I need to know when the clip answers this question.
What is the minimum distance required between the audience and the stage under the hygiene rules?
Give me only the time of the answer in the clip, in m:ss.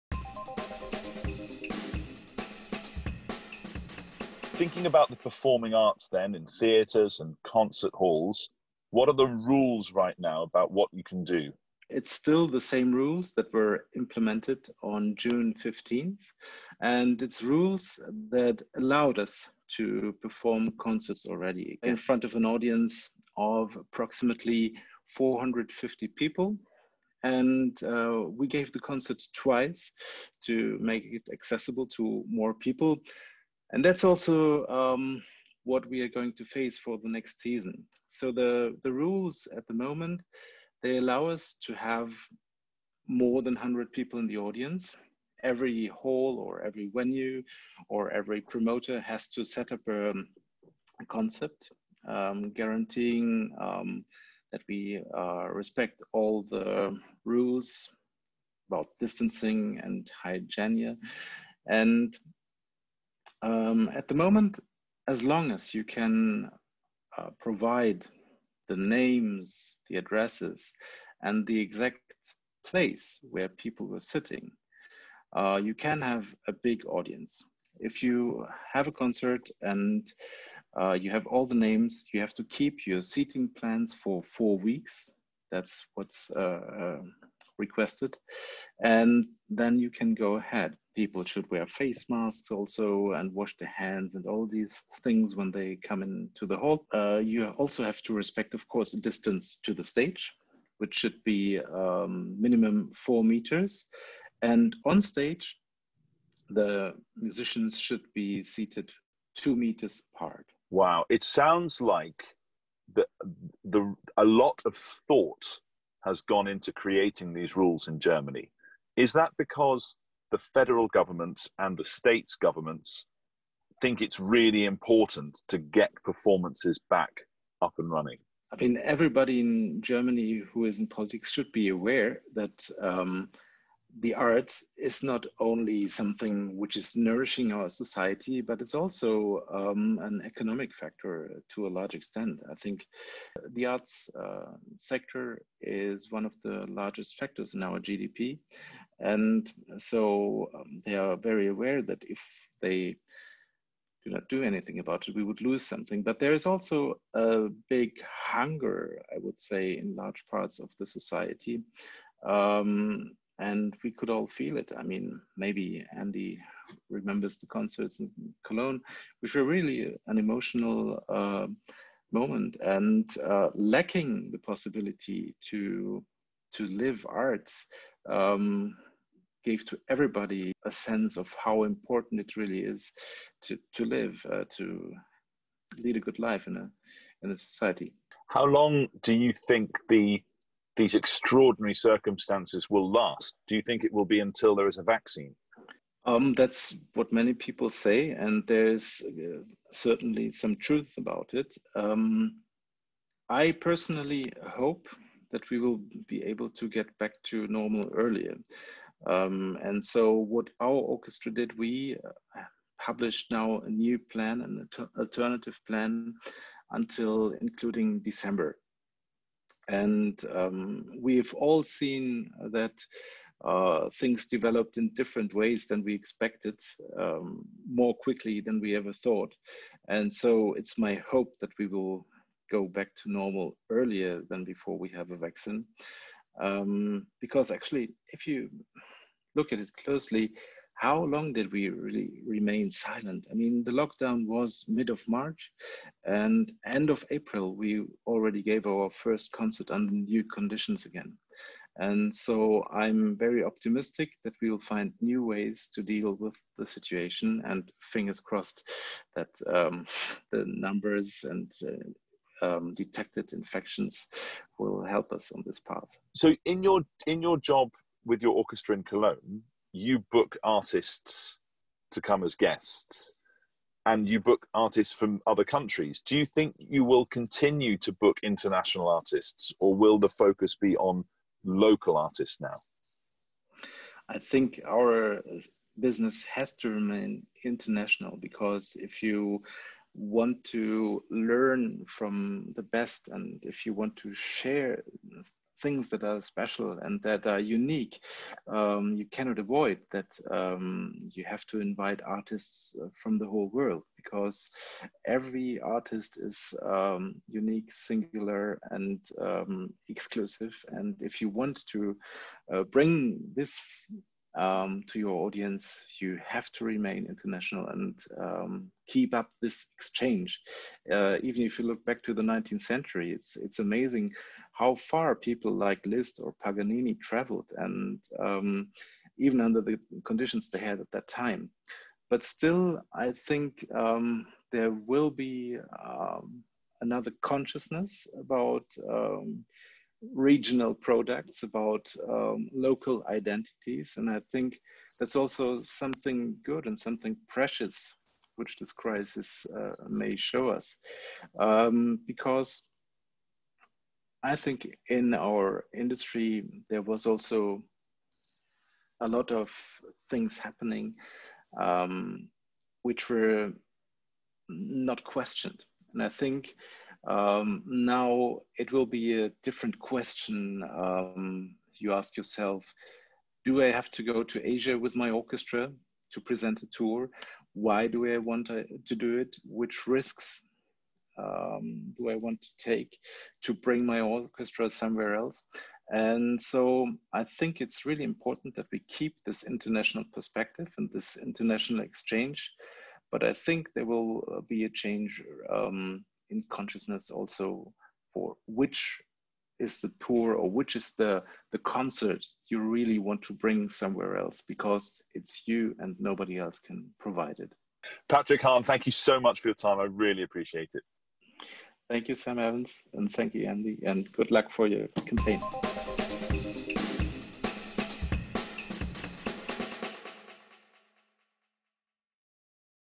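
1:42.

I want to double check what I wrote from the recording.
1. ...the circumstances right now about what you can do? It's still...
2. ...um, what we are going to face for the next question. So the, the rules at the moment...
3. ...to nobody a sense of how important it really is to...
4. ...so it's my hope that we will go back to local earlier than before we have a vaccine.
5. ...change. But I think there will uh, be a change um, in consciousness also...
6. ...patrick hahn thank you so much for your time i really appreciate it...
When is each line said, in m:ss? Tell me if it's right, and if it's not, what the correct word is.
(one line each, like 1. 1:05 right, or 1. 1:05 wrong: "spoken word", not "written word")
1. 0:09 wrong: "rules", not "circumstances"
2. 0:34 wrong: "season", not "question"
3. 2:59 wrong: "everybody", not "nobody"
4. 3:50 wrong: "normal", not "local"
5. 6:31 wrong: "exchange", not "change"
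6. 6:48 right.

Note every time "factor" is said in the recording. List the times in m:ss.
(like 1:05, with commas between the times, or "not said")
2:20, 2:27.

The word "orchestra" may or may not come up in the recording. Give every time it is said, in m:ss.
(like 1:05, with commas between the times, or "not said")
3:30, 4:28, 6:15, 6:23.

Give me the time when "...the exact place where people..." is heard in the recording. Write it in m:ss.
1:11.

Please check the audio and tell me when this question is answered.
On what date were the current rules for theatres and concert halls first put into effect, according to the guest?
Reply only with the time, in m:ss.
0:15.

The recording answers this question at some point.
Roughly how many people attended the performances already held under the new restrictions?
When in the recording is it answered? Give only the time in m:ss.
0:25.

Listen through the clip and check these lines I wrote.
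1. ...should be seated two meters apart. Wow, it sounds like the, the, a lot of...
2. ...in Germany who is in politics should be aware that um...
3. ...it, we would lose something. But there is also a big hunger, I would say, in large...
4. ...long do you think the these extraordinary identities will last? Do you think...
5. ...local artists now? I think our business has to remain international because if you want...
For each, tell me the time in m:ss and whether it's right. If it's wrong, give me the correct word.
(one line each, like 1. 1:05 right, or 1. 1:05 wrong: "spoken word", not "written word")
1. 1:47 right
2. 2:09 right
3. 2:35 right
4. 3:08 wrong: "circumstances", not "identities"
5. 4:41 right.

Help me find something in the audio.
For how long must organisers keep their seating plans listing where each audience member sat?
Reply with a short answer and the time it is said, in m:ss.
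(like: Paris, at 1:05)
4 weeks, at 1:24.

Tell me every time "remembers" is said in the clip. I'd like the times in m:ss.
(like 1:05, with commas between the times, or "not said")
2:46.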